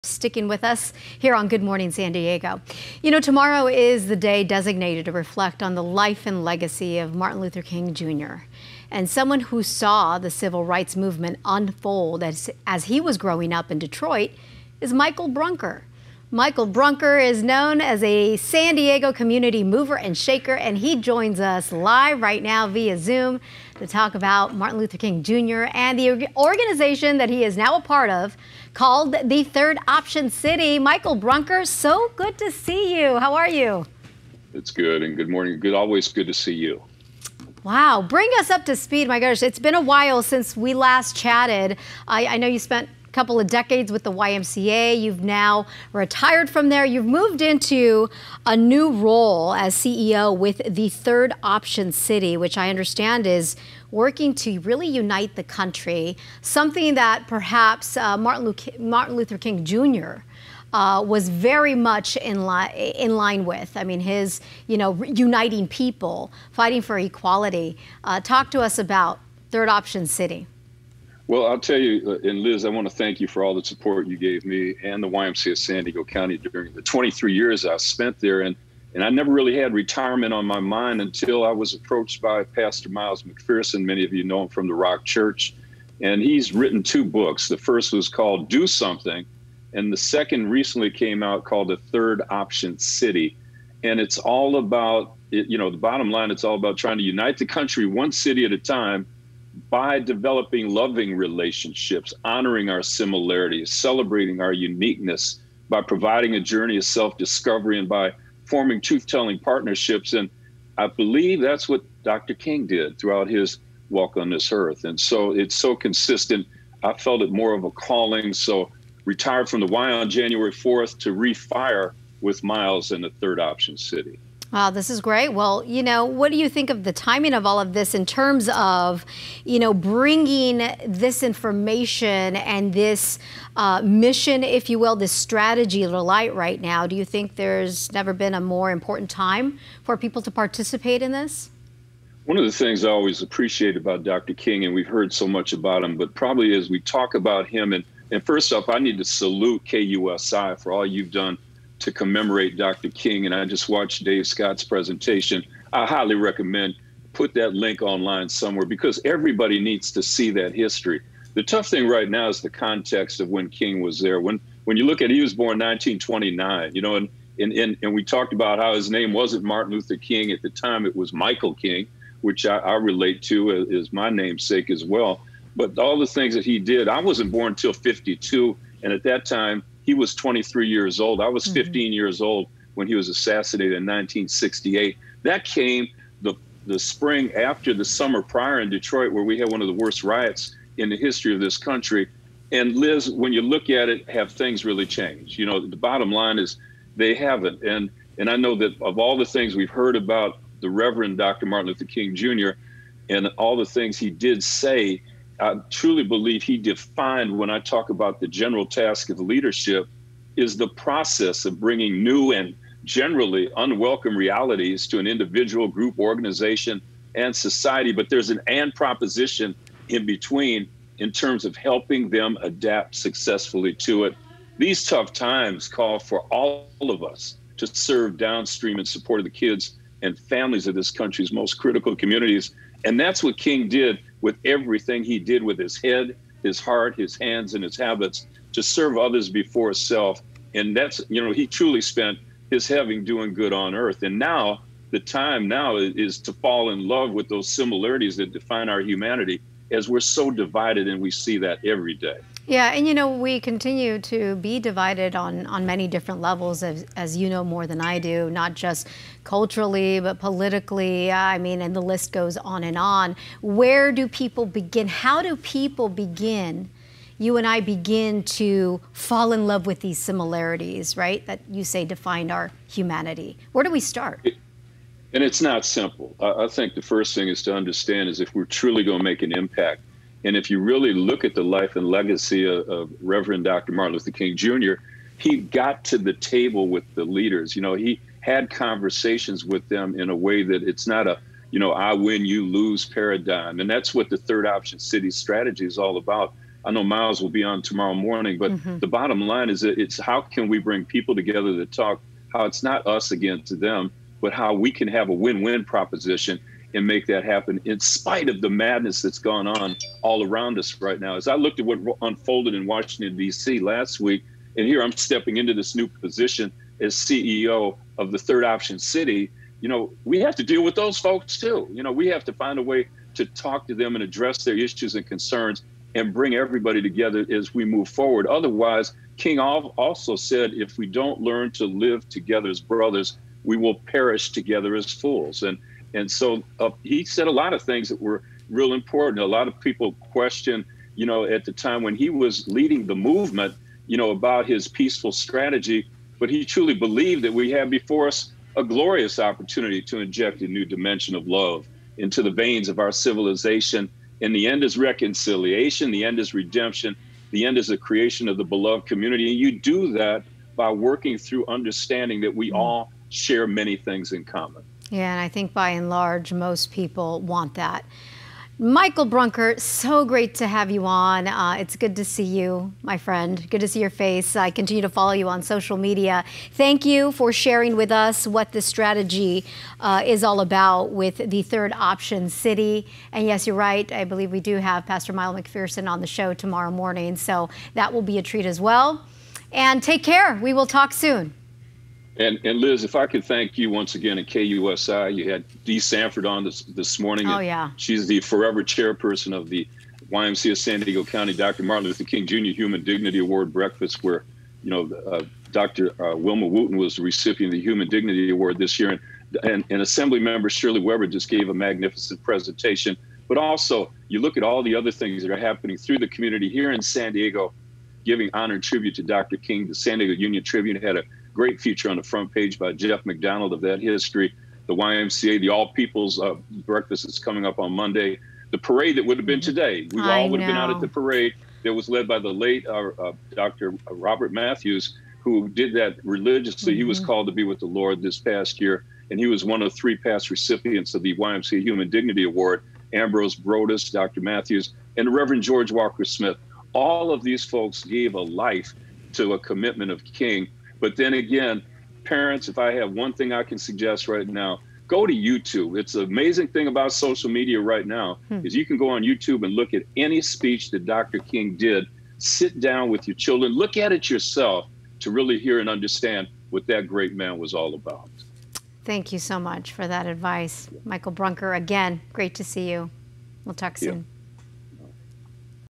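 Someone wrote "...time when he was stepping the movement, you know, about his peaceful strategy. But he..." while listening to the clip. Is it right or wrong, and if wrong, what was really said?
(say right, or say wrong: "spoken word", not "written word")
wrong: "leading", not "stepping".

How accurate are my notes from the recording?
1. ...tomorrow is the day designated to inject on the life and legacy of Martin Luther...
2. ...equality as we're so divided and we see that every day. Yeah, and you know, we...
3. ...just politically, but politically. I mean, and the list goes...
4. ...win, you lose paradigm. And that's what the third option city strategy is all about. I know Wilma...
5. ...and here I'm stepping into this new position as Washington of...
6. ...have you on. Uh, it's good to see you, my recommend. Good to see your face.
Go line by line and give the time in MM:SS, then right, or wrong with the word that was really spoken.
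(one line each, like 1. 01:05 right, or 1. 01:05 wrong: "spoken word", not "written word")
1. 00:03 wrong: "reflect", not "inject"
2. 04:08 wrong: "humanity", not "equality"
3. 04:18 wrong: "culturally", not "politically"
4. 04:51 wrong: "Miles", not "Wilma"
5. 05:14 wrong: "CEO", not "Washington"
6. 06:10 wrong: "friend", not "recommend".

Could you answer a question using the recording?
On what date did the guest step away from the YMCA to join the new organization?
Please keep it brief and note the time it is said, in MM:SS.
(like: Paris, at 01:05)
January 4th, at 02:00.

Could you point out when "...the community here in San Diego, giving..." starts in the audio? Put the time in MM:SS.
06:55.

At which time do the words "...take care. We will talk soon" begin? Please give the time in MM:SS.
06:29.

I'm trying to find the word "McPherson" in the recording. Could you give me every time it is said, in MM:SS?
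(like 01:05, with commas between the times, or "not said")
01:23, 06:25.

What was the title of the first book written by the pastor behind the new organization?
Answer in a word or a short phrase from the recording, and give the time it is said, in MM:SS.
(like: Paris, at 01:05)
Do Something, at 01:28.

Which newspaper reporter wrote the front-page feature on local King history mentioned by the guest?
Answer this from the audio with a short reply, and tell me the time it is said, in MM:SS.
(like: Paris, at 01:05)
Jeff McDonald, at 07:02.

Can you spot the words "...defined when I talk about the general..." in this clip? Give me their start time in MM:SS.
03:26.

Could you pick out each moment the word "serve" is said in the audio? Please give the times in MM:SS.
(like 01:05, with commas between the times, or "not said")
03:47, 03:58.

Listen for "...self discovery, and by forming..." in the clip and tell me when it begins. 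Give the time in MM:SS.
01:46.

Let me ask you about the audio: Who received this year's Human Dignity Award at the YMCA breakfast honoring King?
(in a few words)
Wilma Wooten.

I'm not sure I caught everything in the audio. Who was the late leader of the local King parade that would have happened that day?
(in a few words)
Robert Matthews.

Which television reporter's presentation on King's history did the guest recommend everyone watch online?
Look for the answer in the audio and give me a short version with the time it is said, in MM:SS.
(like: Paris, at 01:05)
Dave Scott, at 02:34.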